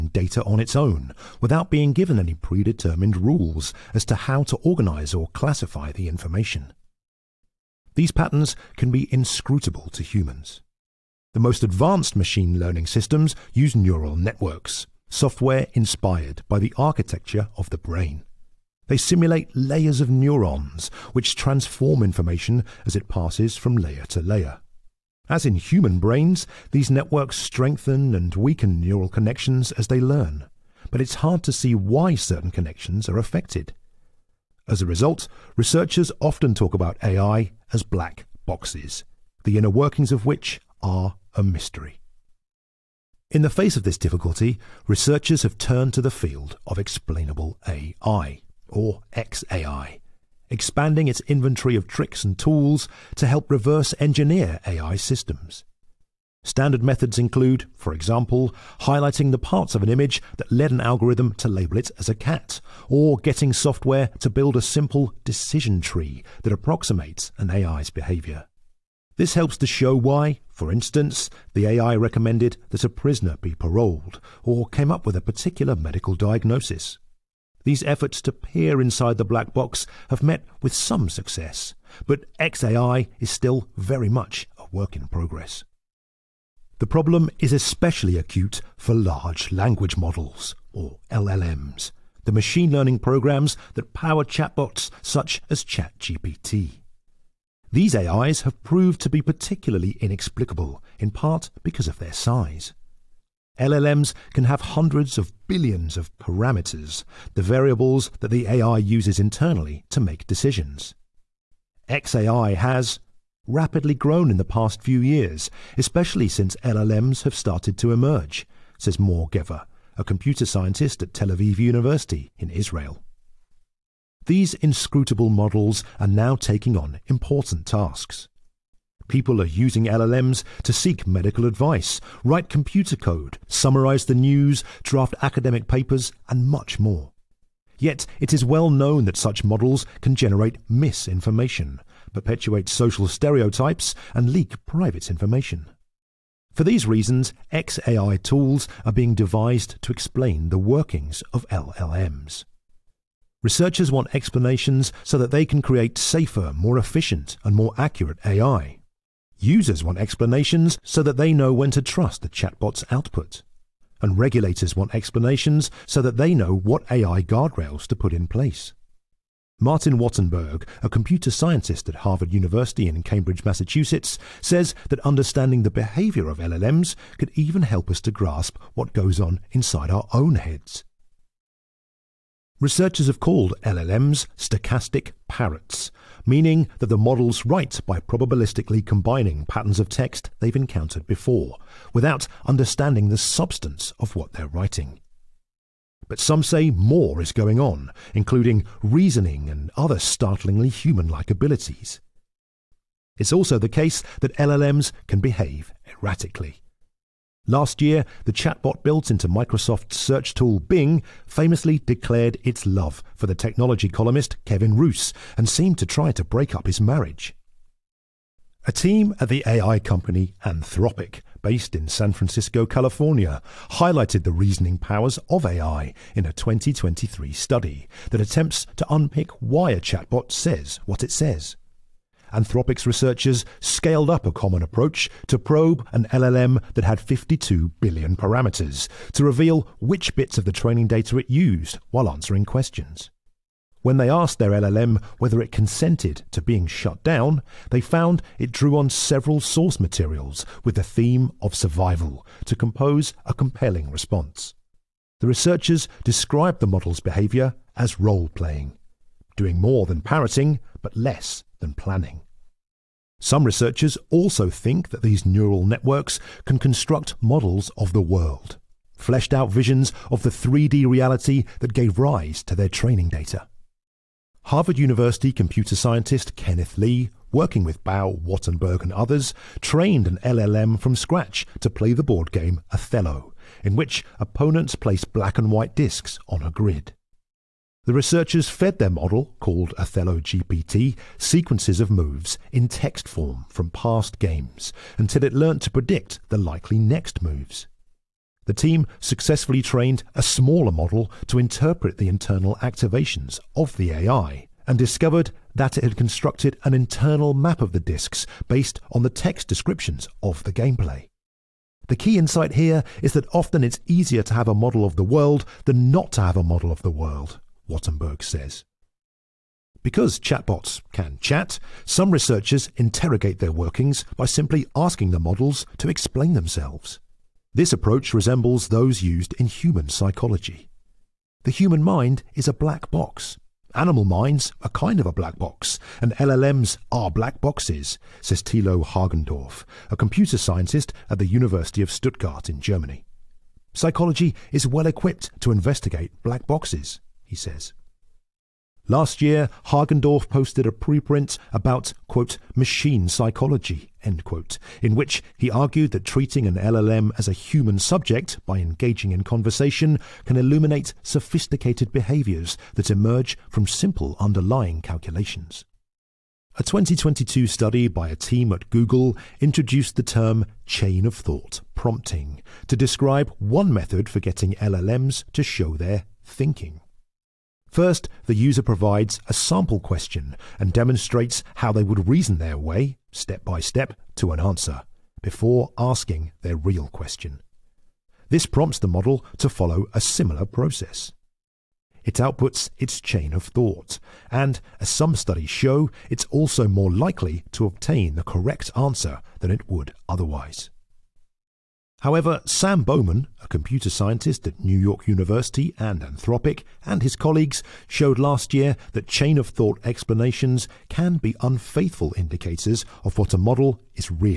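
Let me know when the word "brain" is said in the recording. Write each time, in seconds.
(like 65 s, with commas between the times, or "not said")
17 s, 25 s.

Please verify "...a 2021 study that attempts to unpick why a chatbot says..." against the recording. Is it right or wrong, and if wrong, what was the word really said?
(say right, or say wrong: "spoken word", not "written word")
wrong: "2023", not "2021".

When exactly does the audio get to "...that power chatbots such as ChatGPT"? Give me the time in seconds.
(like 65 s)
93 s.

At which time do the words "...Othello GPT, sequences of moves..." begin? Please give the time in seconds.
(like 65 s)
289 s.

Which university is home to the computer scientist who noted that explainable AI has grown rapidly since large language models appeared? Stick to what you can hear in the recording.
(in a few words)
Tel Aviv University.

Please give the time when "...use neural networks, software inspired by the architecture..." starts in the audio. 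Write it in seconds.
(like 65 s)
13 s.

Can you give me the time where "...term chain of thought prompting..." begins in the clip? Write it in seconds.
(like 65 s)
370 s.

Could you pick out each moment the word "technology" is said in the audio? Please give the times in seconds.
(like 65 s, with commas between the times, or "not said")
213 s.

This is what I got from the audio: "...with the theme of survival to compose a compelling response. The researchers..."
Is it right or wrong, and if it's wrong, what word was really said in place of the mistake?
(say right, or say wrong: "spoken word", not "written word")
right.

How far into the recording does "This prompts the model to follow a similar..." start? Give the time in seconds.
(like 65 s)
388 s.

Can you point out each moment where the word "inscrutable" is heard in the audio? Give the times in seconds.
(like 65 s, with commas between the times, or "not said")
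9 s, 124 s.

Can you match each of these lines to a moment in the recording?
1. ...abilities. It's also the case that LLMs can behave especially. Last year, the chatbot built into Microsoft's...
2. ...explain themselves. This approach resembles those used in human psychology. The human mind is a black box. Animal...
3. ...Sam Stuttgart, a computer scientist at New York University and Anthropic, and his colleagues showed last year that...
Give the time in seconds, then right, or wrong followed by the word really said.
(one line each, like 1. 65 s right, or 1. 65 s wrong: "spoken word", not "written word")
1. 201 s wrong: "erratically", not "especially"
2. 325 s right
3. 402 s wrong: "Bowman", not "Stuttgart".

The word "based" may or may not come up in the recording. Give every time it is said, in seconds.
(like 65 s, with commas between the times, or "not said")
221 s, 308 s.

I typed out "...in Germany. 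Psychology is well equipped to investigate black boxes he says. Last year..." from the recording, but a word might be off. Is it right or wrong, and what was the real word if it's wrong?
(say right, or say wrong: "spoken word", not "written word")
right.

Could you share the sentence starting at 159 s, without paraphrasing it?
Users want explanations so that they know when to trust the chatbot's output.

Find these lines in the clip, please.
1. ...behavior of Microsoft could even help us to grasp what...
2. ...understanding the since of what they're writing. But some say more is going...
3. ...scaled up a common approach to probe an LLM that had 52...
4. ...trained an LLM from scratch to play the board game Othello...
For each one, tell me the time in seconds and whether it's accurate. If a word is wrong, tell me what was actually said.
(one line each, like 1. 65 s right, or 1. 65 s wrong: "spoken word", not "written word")
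1. 175 s wrong: "LLMs", not "Microsoft"
2. 192 s wrong: "substance", not "since"
3. 233 s right
4. 279 s right.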